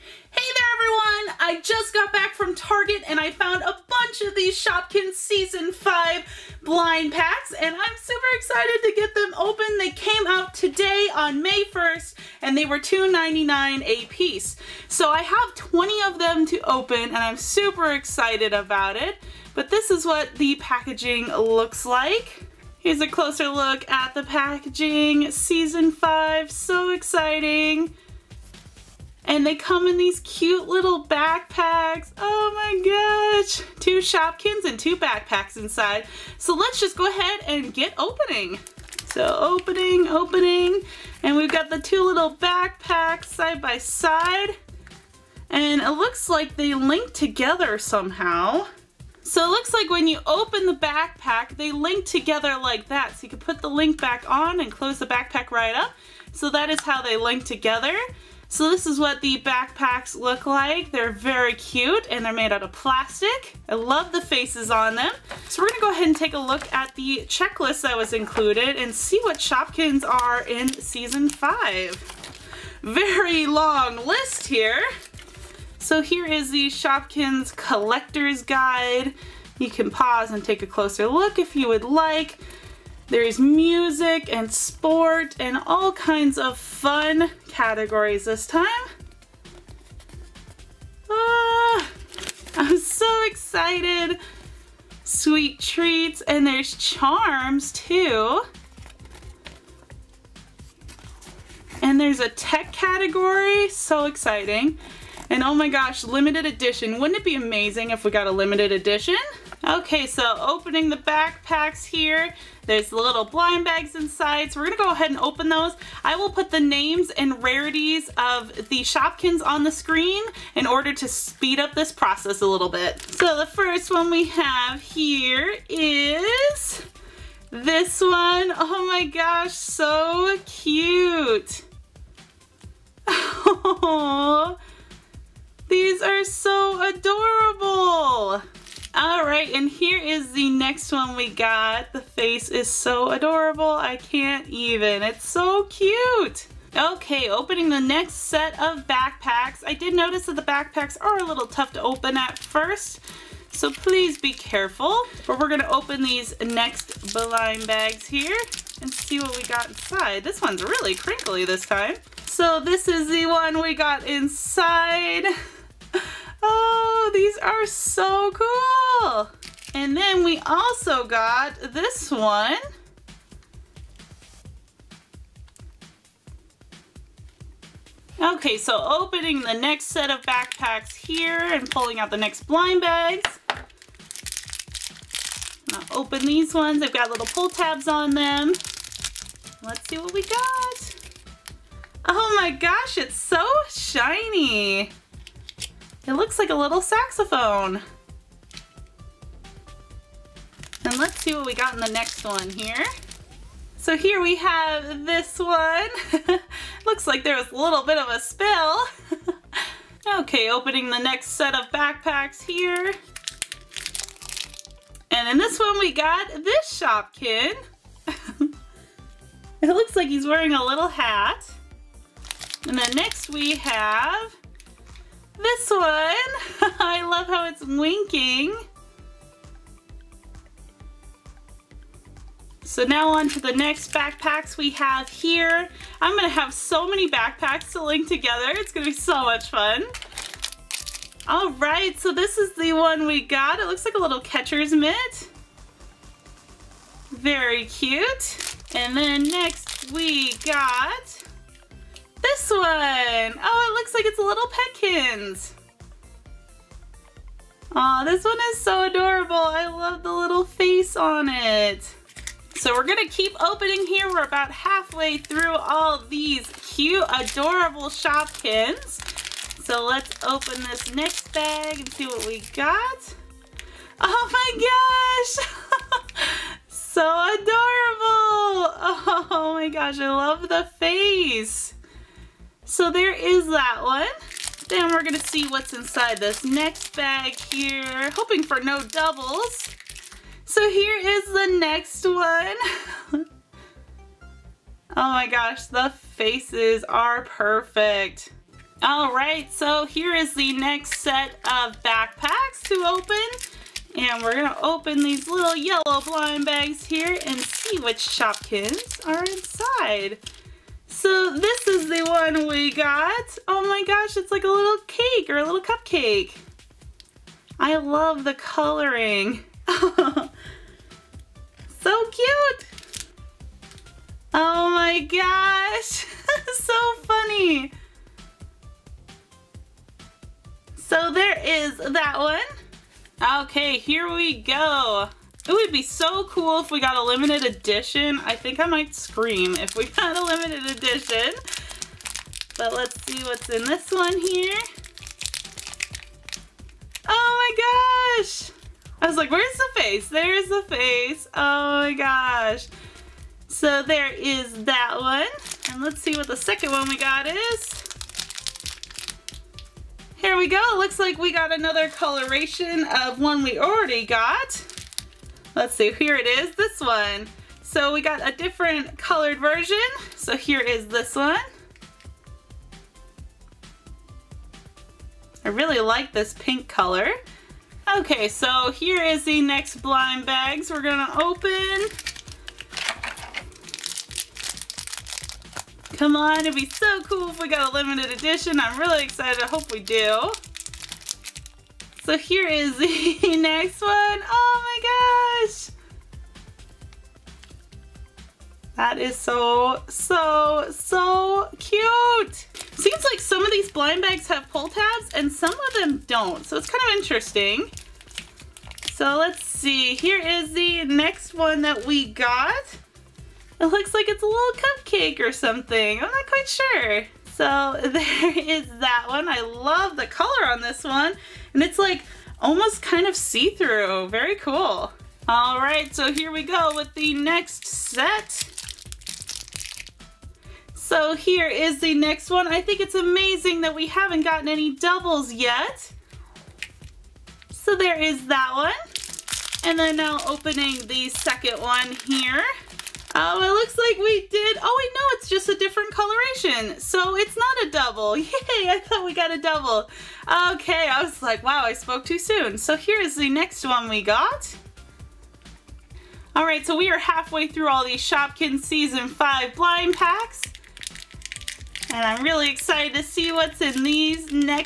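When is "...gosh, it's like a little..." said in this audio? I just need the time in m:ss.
5:13.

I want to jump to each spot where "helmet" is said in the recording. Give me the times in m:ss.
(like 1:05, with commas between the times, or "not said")
not said.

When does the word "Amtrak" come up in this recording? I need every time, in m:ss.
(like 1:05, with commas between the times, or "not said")
not said.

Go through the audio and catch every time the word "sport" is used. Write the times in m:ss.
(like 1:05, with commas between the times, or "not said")
1:24.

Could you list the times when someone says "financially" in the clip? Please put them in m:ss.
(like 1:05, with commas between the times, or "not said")
not said.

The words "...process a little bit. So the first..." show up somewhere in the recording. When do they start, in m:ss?
2:01.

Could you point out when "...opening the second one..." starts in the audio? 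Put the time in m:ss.
7:20.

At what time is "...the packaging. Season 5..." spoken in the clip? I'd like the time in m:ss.
0:24.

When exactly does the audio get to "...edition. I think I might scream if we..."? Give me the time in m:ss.
5:37.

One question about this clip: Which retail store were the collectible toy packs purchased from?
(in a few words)
Target.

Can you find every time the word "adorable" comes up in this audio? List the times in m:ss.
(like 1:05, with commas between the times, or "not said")
2:16, 2:23, 4:18, 4:27, 4:37.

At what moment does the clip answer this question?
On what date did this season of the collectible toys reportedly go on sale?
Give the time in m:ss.
0:11.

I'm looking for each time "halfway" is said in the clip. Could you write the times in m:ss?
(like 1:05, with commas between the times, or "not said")
4:24, 7:36.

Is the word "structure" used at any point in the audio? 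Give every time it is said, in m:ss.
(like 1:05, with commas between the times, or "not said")
not said.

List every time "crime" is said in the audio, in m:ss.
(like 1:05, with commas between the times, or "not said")
not said.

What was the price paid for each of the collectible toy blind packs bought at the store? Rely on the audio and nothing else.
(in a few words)
$2.99.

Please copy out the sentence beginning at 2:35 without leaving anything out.
But we're gonna open these next blind bags here and see what we got inside.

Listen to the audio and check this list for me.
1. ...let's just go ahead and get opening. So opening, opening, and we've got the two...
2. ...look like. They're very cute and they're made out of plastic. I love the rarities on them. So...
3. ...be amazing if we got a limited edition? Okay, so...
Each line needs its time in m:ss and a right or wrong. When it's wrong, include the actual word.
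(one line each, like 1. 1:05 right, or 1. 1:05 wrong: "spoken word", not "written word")
1. 0:36 right
2. 1:00 wrong: "faces", not "rarities"
3. 1:47 right.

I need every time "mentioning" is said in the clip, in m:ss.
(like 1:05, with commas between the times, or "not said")
not said.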